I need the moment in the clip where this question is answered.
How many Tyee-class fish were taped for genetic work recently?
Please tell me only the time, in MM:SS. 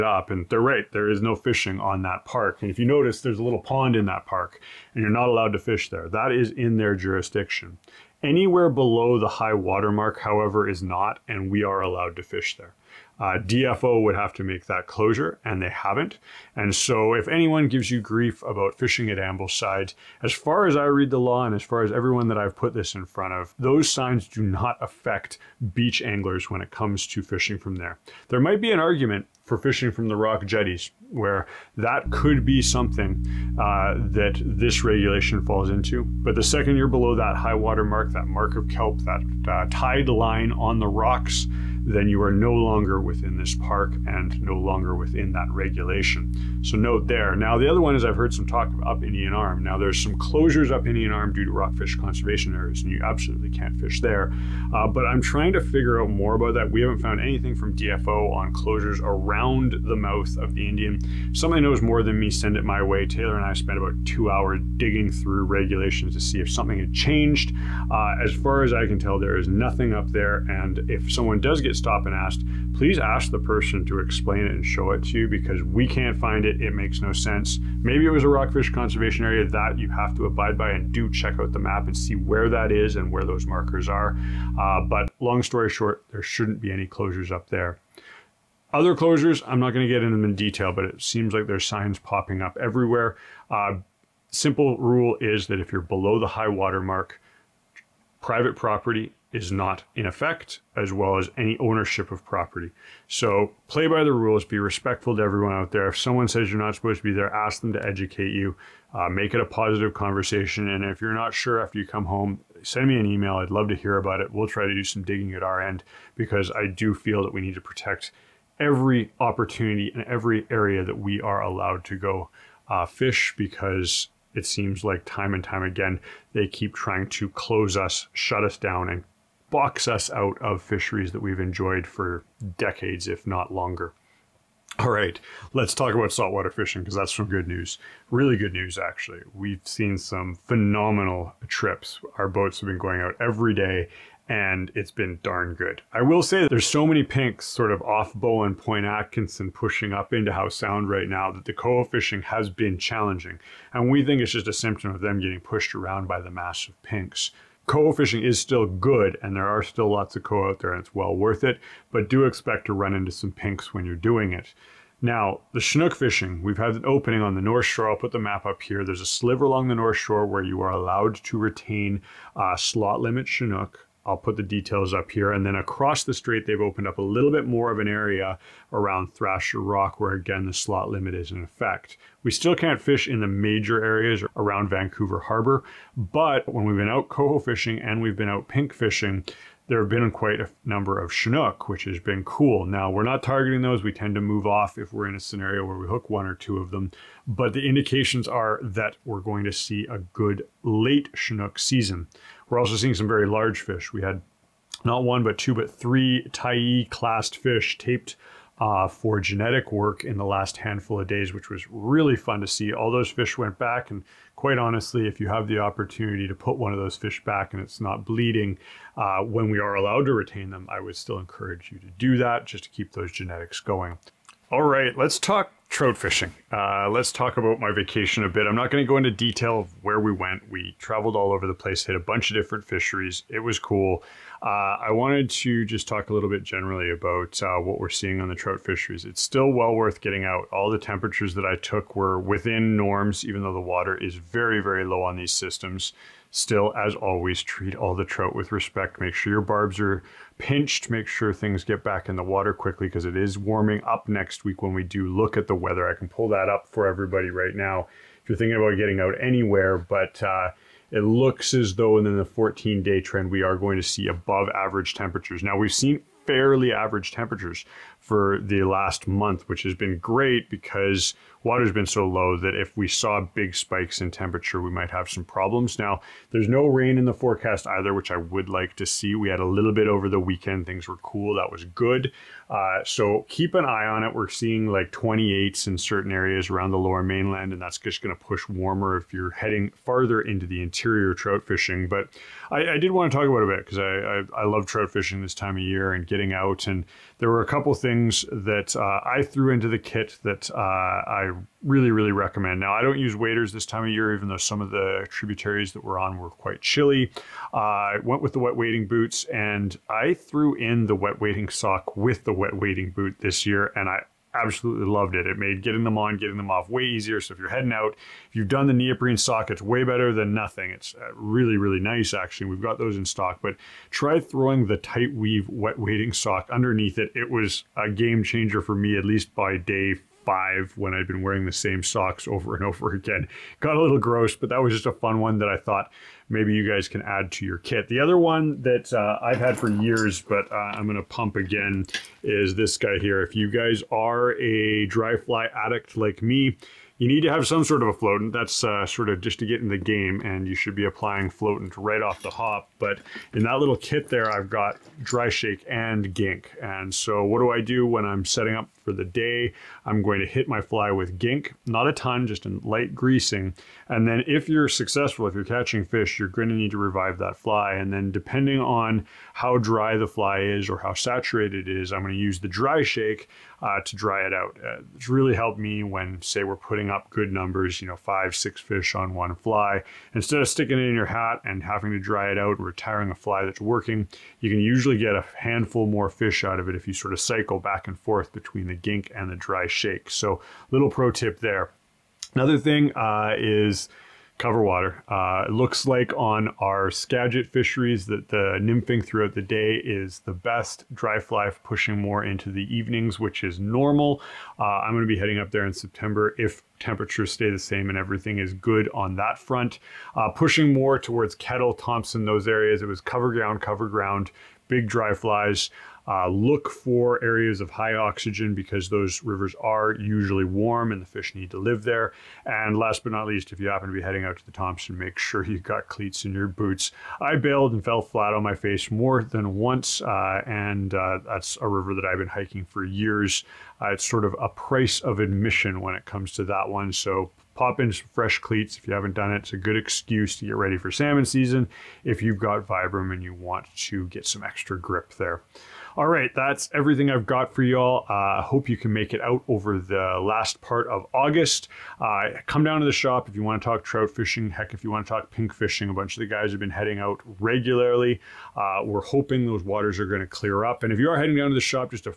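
03:25.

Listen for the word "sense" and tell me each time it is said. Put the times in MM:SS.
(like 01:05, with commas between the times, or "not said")
01:17.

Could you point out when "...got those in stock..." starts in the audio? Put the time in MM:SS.
05:22.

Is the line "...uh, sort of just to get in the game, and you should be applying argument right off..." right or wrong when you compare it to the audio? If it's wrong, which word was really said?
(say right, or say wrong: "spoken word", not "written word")
wrong: "floatant", not "argument".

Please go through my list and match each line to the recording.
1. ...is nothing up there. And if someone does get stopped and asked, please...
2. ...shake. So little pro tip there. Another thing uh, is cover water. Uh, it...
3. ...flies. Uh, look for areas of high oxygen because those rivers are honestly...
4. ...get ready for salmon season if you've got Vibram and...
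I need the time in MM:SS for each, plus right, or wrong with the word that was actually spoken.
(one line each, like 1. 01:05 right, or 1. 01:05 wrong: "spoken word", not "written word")
1. 01:09 right
2. 06:29 right
3. 06:55 wrong: "usually", not "honestly"
4. 07:20 right.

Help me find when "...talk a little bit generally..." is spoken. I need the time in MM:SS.
03:55.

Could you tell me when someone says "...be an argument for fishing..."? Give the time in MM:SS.
00:28.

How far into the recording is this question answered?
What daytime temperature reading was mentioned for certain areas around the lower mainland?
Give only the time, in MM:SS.
04:44.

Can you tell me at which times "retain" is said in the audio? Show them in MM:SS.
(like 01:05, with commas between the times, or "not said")
02:51, 03:40.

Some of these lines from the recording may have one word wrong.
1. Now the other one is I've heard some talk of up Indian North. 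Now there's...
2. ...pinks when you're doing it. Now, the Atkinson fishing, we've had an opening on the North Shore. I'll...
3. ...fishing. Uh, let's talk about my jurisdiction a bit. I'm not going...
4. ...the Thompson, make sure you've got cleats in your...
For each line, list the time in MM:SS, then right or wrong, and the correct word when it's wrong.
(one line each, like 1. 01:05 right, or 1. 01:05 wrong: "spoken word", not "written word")
1. 00:47 wrong: "Arm", not "North"
2. 02:43 wrong: "Chinook", not "Atkinson"
3. 03:45 wrong: "vacation", not "jurisdiction"
4. 07:04 right.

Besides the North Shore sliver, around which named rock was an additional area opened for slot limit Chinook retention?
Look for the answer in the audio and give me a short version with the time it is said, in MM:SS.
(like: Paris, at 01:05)
Thrasher Rock, at 02:59.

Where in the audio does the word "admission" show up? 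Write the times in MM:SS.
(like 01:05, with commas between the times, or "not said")
07:15.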